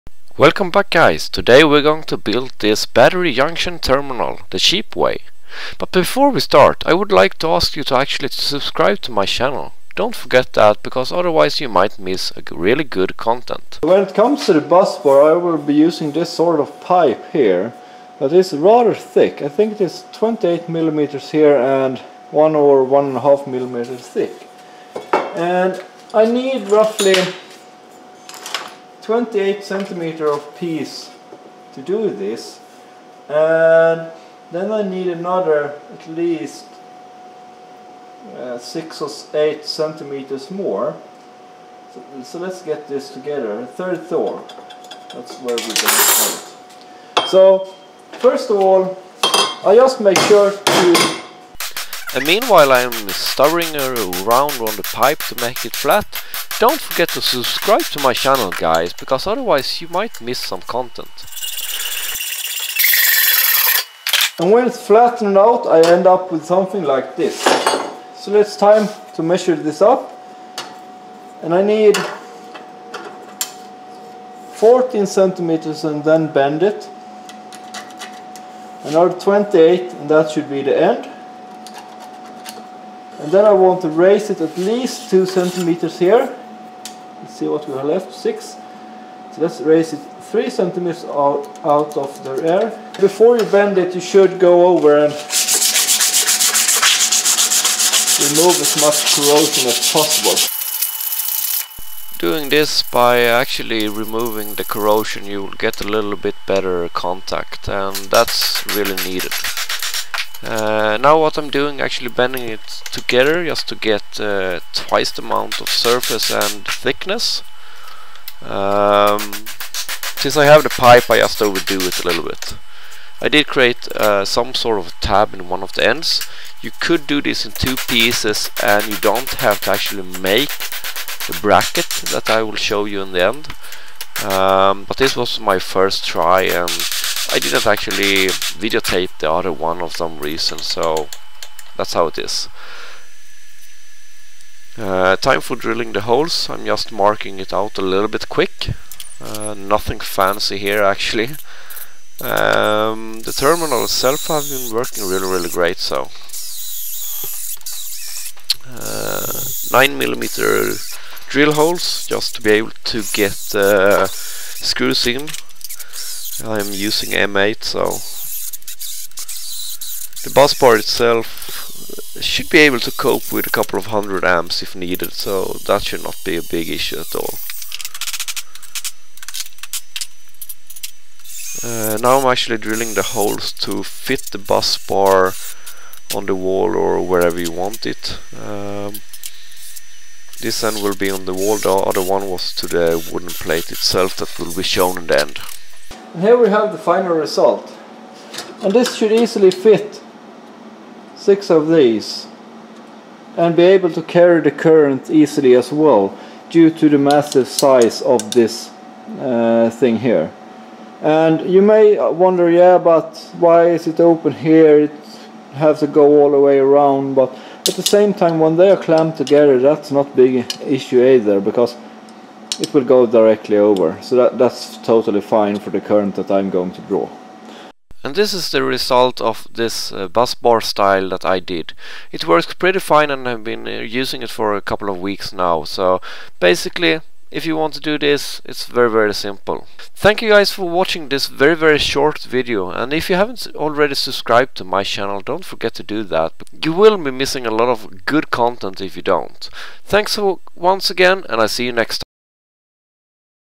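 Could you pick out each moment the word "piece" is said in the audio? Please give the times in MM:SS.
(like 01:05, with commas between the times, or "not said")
00:30, 02:07.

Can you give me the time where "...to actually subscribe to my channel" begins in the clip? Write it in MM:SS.
00:07.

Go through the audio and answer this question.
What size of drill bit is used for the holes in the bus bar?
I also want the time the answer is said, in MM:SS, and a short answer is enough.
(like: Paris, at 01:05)
9 millimeter, at 02:39.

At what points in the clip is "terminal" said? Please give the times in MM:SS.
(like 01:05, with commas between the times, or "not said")
00:03, 02:33.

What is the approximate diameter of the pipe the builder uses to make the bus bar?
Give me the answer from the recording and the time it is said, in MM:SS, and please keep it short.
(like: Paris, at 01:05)
28 mm, at 00:20.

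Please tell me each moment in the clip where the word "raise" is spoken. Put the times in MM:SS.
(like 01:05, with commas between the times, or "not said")
01:23, 01:29.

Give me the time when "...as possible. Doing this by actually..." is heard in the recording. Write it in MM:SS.
01:39.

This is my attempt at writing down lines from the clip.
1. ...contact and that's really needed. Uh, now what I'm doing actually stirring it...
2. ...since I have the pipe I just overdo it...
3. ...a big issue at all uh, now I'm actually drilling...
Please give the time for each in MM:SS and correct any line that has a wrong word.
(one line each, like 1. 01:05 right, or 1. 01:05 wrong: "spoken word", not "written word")
1. 01:46 wrong: "bending", not "stirring"
2. 02:00 right
3. 02:56 right.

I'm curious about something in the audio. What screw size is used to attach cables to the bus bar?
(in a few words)
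M8.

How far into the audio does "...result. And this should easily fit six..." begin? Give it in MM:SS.
03:17.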